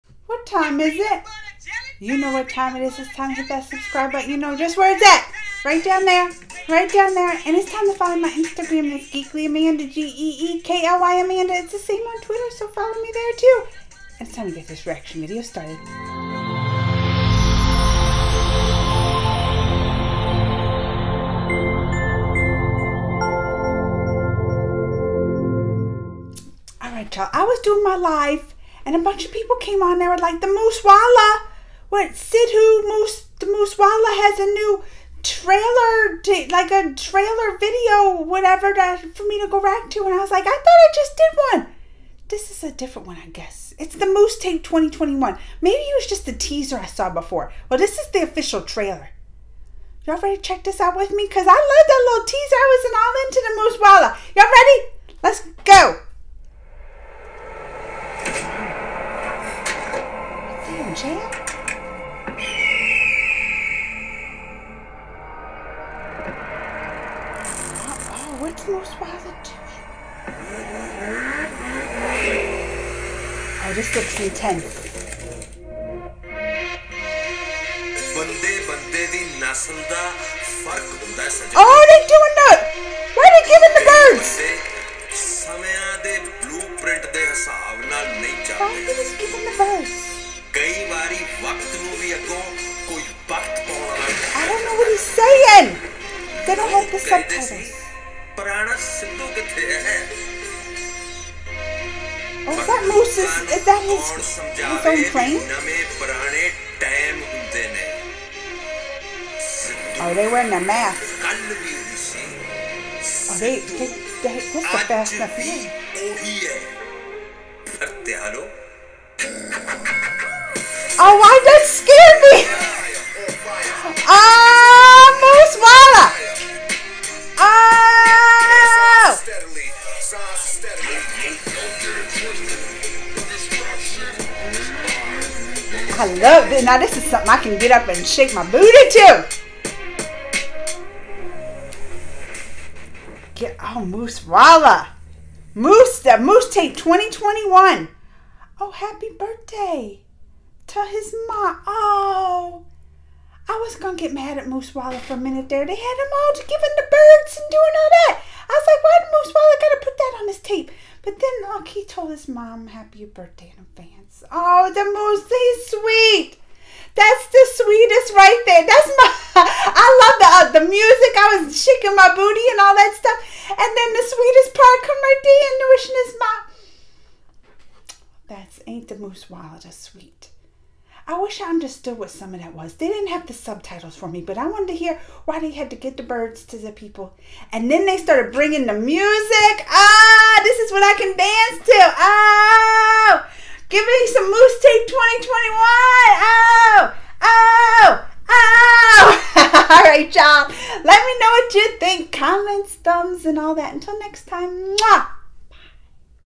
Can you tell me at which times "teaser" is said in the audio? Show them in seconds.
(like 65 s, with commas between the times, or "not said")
46 s, 52 s.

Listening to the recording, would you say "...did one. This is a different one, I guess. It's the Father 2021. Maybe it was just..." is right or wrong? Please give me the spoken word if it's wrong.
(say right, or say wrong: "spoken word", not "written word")
wrong: "Moosetape", not "Father".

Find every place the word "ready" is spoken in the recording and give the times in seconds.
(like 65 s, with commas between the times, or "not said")
50 s, 54 s.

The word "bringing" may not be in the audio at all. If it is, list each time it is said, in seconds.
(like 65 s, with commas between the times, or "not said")
188 s.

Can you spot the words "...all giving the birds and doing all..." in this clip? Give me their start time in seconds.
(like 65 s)
156 s.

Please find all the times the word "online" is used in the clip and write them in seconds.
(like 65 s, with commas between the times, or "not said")
not said.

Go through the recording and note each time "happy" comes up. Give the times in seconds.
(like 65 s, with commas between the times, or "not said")
148 s, 162 s.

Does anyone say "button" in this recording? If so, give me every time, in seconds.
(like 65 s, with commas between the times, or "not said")
4 s.